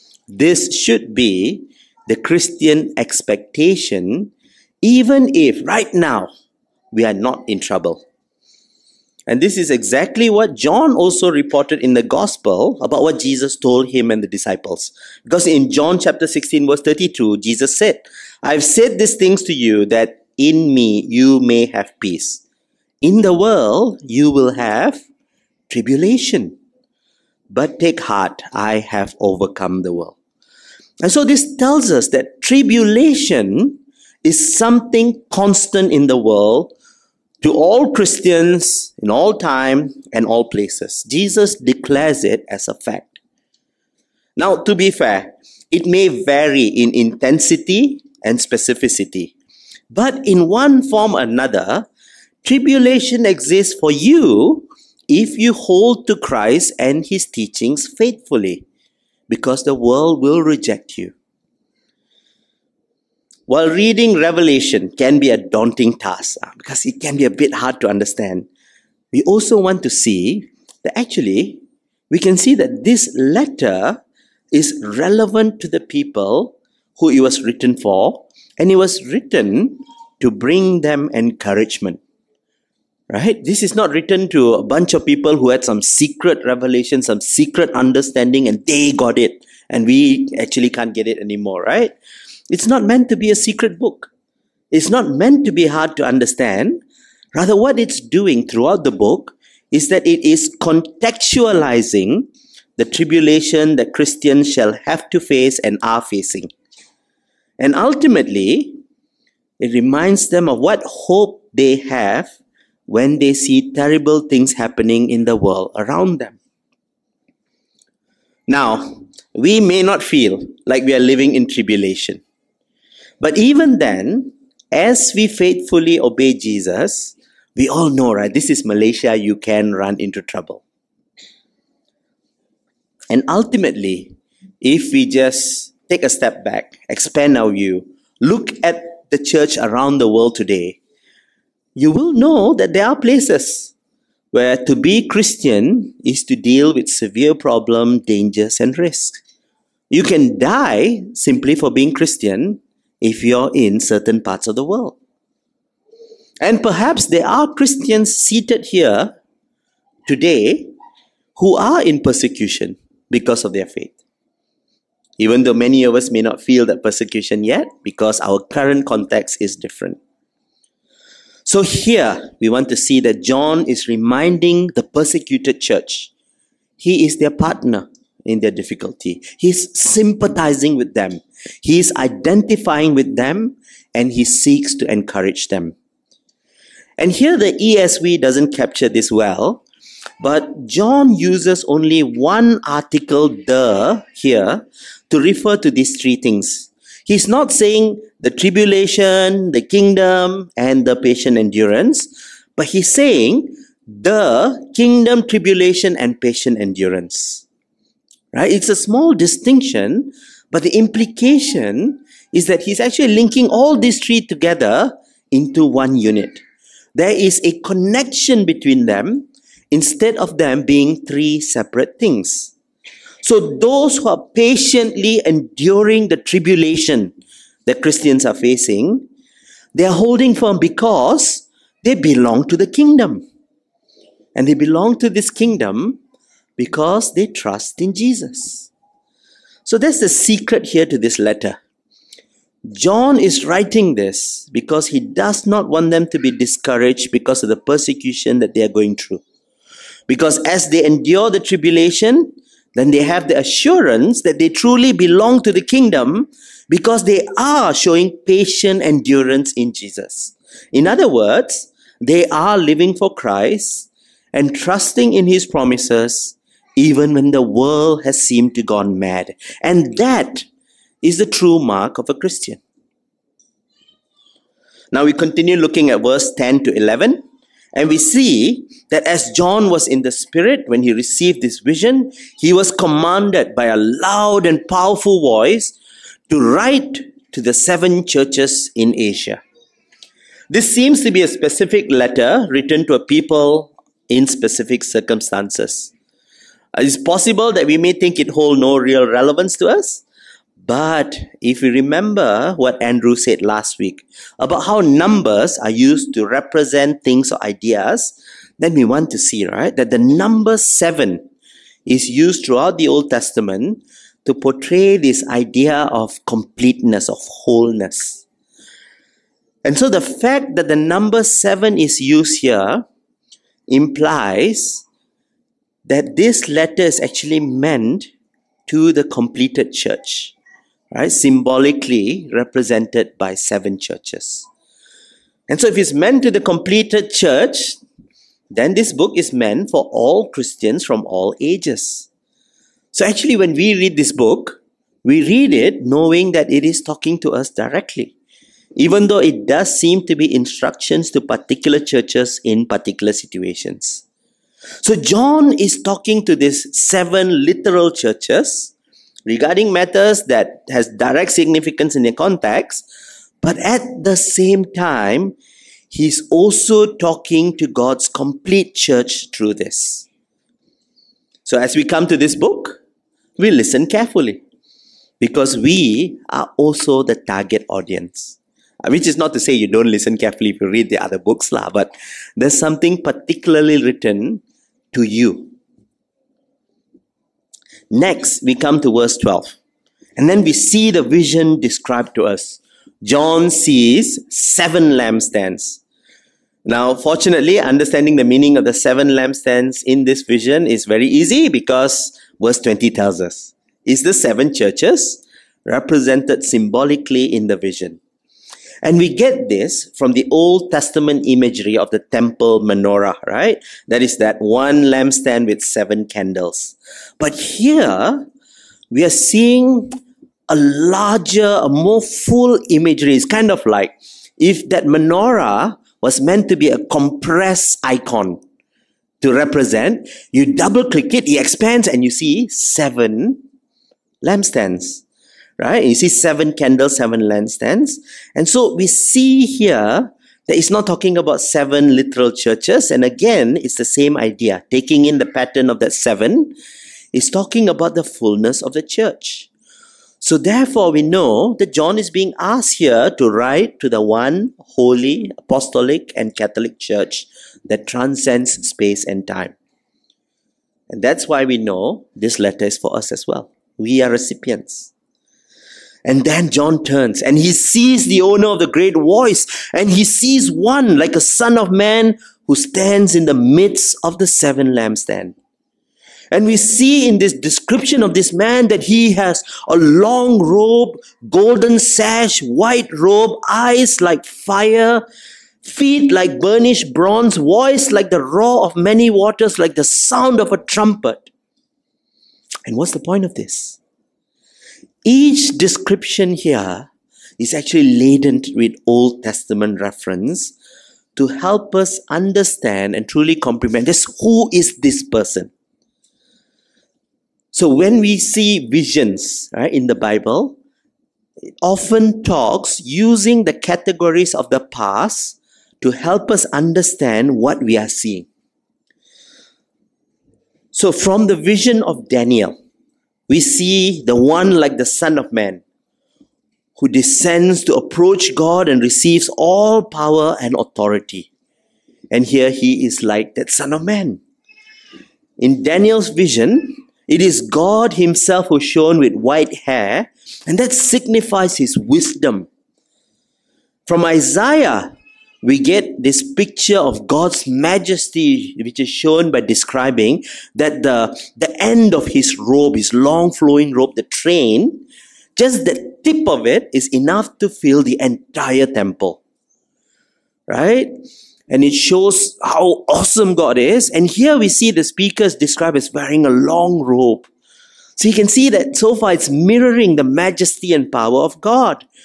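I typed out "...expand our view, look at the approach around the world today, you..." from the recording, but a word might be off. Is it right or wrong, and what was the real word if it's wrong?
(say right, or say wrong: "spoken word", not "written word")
wrong: "church", not "approach".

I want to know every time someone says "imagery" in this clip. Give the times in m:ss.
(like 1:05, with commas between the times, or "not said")
6:51, 7:02.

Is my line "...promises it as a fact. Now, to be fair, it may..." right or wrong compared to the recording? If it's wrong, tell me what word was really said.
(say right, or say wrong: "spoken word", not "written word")
wrong: "declares", not "promises".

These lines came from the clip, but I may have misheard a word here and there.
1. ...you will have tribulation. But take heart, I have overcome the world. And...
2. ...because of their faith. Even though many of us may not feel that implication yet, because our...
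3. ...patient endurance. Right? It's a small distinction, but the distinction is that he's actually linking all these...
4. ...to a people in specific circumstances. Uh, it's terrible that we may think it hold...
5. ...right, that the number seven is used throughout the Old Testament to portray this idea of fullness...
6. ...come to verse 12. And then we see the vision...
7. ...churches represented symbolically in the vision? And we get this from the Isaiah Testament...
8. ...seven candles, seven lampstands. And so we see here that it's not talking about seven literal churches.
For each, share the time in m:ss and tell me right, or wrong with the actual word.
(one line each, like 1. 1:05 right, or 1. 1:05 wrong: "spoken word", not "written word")
1. 0:24 right
2. 2:43 wrong: "persecution", not "implication"
3. 3:26 wrong: "implication", not "distinction"
4. 4:52 wrong: "possible", not "terrible"
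5. 5:09 wrong: "completeness", not "fullness"
6. 6:28 right
7. 6:44 wrong: "Old", not "Isaiah"
8. 7:16 right.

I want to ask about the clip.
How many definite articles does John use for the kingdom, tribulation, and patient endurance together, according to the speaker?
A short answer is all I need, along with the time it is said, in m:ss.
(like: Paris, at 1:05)
1, at 3:11.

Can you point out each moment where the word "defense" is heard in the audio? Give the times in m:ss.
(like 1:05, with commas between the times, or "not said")
not said.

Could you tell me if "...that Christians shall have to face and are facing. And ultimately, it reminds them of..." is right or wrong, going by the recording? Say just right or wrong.
right.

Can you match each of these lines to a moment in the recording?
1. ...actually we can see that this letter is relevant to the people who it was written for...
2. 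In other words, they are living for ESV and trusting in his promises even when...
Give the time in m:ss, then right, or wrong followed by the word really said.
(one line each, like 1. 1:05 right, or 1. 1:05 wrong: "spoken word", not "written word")
1. 1:10 right
2. 4:20 wrong: "Christ", not "ESV".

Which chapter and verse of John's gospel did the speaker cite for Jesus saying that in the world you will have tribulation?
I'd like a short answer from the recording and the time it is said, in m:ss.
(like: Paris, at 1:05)
John 16:32, at 0:15.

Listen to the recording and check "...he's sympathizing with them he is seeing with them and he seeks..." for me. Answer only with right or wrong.
wrong.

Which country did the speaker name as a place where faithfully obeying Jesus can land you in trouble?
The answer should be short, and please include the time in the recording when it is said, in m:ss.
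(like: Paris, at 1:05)
Malaysia, at 2:08.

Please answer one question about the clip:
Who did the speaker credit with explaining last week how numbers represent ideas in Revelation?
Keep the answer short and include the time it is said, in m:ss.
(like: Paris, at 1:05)
Andrew, at 5:02.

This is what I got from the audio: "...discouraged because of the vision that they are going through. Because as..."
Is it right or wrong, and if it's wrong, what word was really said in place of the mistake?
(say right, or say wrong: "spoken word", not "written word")
wrong: "persecution", not "vision".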